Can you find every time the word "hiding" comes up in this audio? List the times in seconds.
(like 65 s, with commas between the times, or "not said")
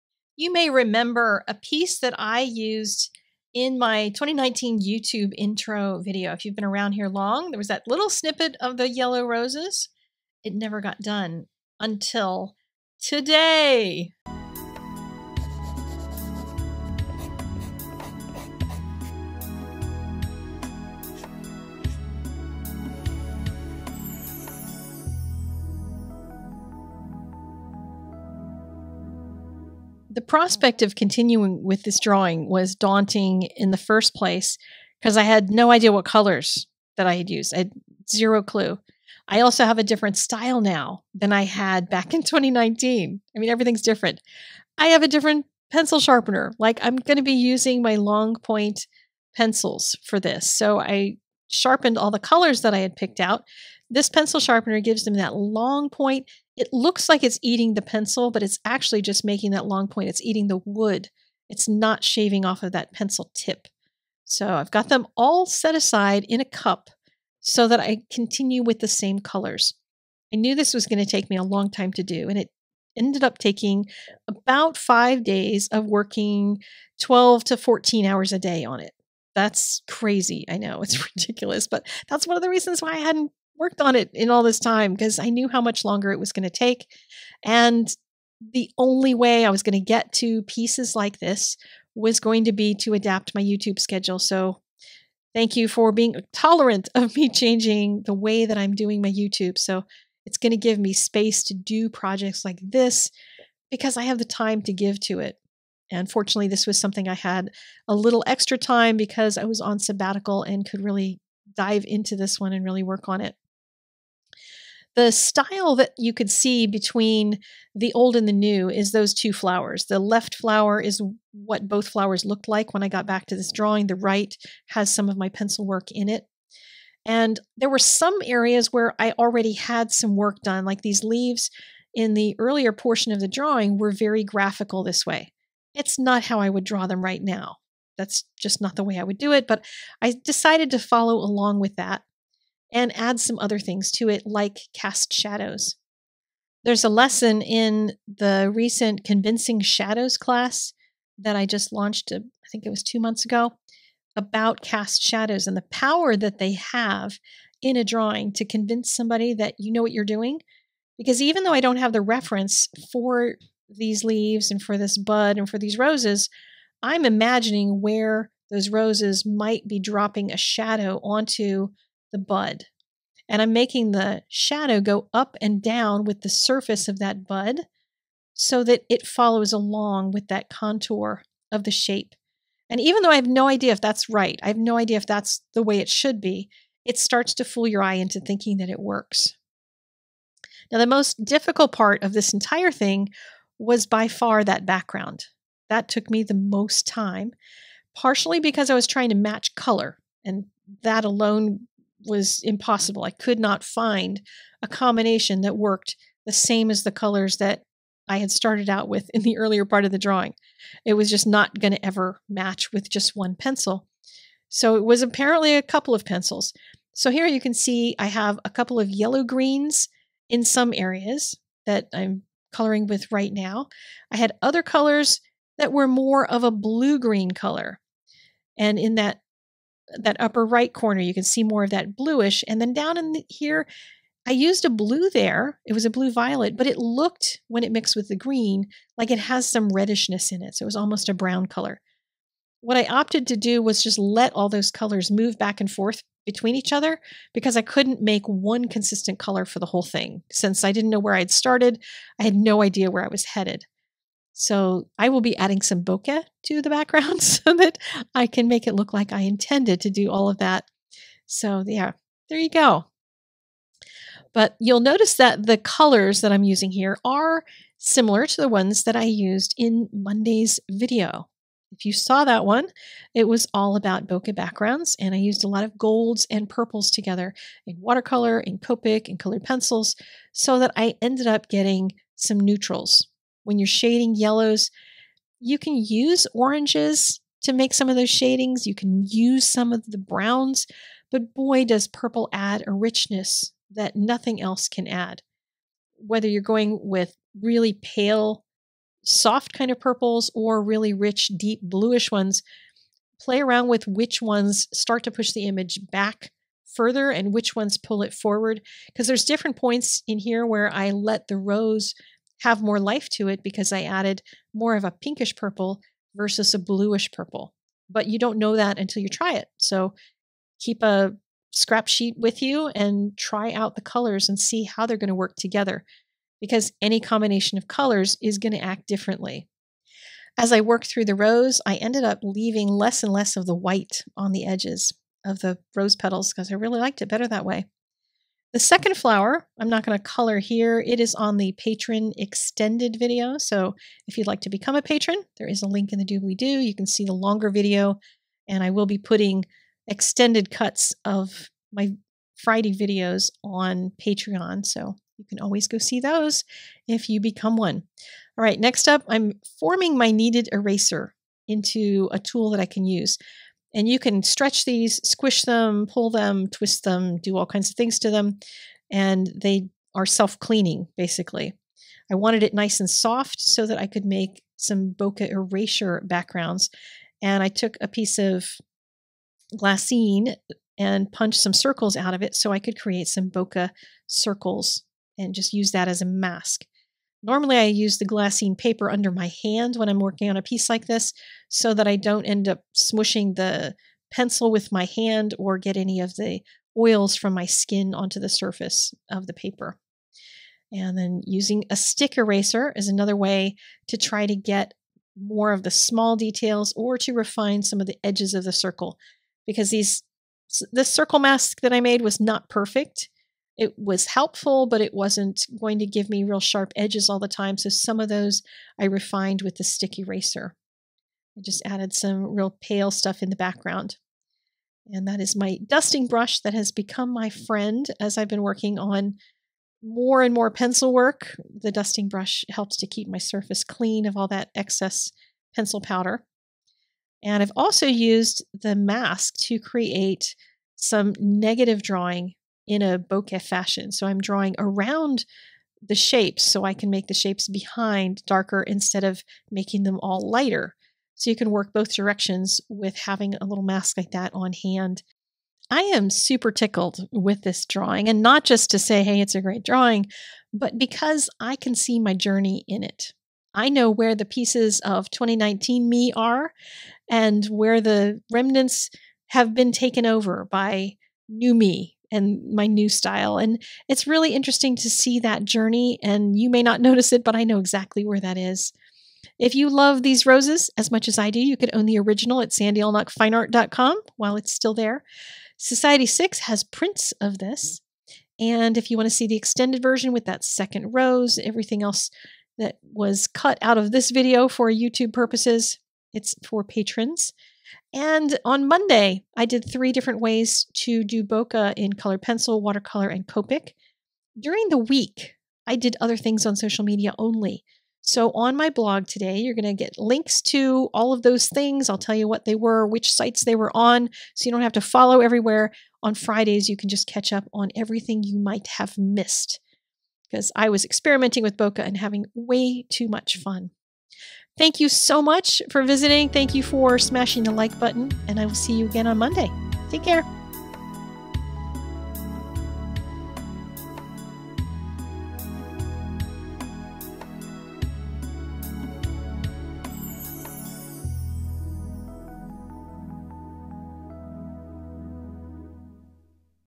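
not said.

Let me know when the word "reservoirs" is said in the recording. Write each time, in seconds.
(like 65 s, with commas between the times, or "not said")
not said.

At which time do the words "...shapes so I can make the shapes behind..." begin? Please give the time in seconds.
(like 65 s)
445 s.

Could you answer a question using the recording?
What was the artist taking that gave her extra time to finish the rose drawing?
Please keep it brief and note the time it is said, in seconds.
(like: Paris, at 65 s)
Sabbatical, at 109 s.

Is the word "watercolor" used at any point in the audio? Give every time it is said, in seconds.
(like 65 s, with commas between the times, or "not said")
277 s, 502 s.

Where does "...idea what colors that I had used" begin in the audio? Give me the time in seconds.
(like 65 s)
35 s.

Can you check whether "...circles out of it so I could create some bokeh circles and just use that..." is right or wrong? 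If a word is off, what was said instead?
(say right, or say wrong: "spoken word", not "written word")
right.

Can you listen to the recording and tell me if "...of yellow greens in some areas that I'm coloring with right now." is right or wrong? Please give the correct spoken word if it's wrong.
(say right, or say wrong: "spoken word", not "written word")
right.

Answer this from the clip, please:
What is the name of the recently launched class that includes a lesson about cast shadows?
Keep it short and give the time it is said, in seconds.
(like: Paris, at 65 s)
Convincing Shadows, at 149 s.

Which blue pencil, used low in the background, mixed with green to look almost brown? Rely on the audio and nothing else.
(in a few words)
Blue violet.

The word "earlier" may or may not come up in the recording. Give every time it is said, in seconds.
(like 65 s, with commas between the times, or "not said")
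132 s, 209 s.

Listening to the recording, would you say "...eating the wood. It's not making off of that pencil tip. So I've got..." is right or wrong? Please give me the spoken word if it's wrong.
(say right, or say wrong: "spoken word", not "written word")
wrong: "shaving", not "making".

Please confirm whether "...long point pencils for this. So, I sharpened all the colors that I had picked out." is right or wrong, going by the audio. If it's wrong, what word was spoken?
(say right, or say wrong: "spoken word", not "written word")
right.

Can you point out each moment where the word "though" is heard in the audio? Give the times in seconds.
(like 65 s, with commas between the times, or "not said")
161 s, 183 s.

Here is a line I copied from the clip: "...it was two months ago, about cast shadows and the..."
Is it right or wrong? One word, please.
right.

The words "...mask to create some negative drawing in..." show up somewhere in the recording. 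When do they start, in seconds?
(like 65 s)
438 s.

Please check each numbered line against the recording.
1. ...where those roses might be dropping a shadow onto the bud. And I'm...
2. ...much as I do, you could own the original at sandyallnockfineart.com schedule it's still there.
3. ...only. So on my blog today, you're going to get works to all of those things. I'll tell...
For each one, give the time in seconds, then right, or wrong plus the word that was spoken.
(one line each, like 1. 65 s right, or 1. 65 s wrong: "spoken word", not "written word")
1. 167 s right
2. 480 s wrong: "while", not "schedule"
3. 507 s wrong: "links", not "works".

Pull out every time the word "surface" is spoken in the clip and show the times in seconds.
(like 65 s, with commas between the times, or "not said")
176 s, 398 s, 433 s.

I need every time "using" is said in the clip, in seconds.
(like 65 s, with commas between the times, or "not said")
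47 s, 266 s, 401 s.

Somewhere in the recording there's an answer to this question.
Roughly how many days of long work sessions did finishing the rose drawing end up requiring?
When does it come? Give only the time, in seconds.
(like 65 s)
74 s.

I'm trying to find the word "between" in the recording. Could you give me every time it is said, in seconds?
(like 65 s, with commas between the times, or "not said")
116 s, 246 s.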